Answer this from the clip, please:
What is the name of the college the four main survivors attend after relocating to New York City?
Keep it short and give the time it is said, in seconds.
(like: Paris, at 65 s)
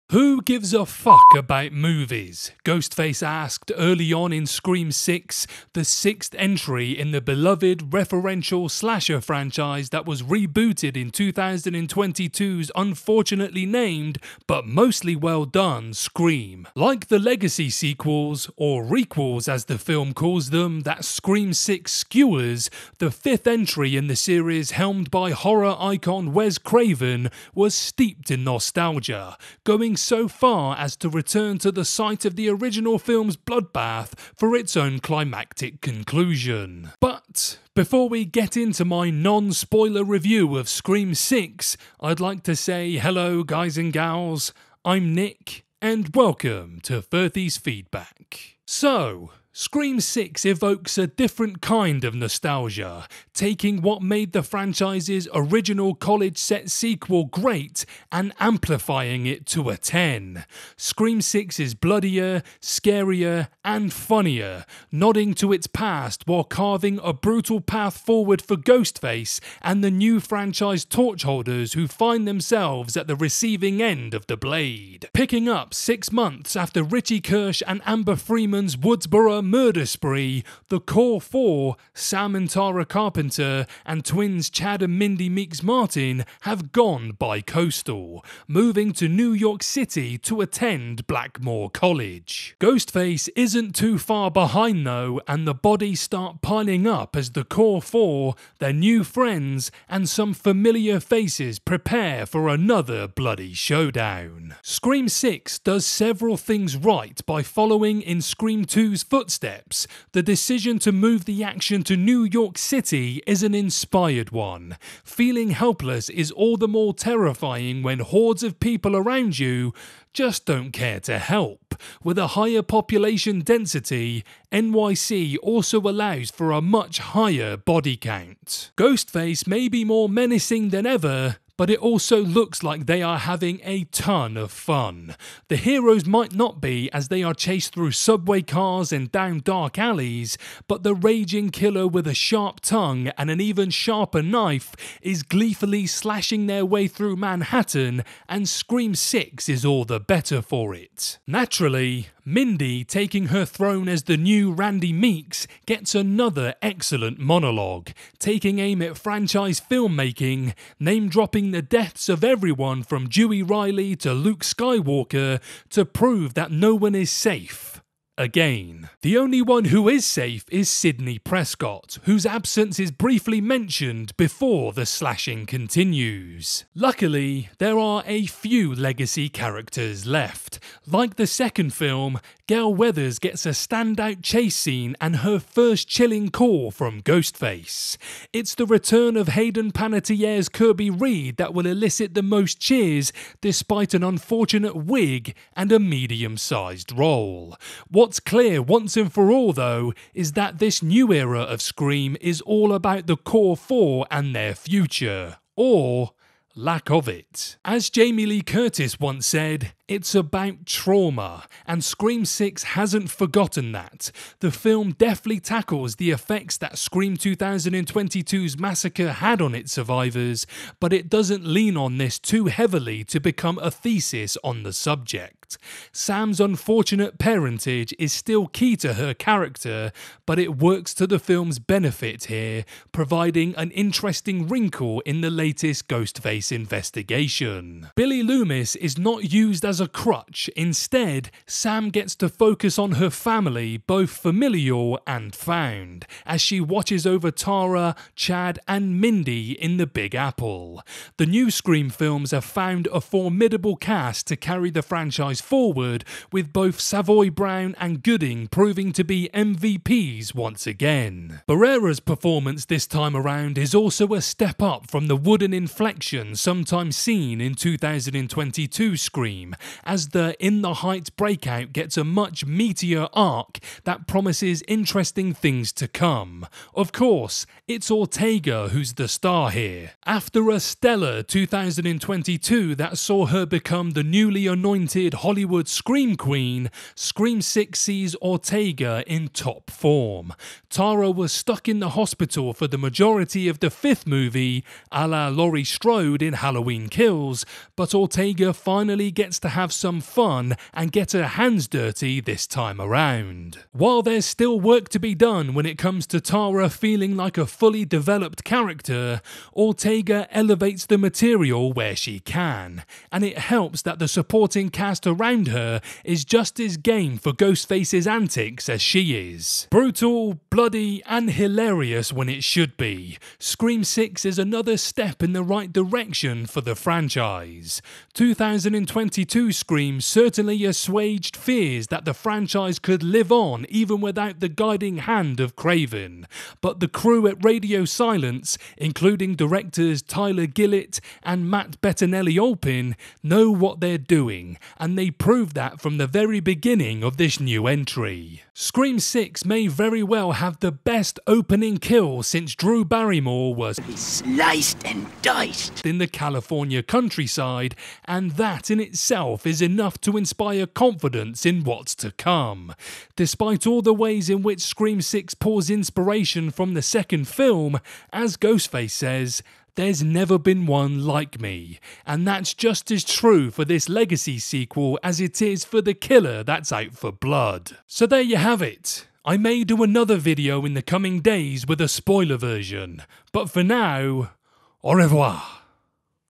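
Blackmore College, at 91 s.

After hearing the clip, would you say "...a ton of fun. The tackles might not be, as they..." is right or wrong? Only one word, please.
wrong.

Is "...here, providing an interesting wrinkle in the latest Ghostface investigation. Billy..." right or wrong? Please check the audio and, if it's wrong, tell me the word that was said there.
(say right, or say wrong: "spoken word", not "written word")
right.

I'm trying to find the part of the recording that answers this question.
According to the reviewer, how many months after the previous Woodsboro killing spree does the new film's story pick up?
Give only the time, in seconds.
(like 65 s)
75 s.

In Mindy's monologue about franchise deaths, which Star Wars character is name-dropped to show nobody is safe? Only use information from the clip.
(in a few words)
Luke Skywalker.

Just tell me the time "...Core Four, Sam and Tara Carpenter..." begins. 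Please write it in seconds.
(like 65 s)
80 s.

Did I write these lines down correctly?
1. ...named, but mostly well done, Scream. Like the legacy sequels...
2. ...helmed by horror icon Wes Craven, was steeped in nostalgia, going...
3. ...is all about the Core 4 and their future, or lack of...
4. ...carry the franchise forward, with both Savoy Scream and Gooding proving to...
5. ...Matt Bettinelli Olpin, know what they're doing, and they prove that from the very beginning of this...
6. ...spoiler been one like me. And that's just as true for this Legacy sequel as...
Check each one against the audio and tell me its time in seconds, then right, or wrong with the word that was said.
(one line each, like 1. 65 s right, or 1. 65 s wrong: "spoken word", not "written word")
1. 13 s right
2. 24 s right
3. 202 s right
4. 254 s wrong: "Brown", not "Scream"
5. 341 s right
6. 370 s wrong: "never", not "spoiler".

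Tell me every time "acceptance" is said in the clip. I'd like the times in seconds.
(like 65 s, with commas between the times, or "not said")
not said.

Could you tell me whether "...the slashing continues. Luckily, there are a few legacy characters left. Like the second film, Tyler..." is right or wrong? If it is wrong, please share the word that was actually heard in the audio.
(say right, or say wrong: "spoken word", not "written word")
wrong: "Gale", not "Tyler".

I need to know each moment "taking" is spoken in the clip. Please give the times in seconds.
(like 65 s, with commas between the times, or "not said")
53 s, 152 s, 158 s.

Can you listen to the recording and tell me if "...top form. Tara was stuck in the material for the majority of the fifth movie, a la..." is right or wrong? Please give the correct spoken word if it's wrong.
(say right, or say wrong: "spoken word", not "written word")
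wrong: "hospital", not "material".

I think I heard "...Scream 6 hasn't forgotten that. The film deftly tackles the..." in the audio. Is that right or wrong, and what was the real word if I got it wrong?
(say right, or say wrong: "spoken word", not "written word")
right.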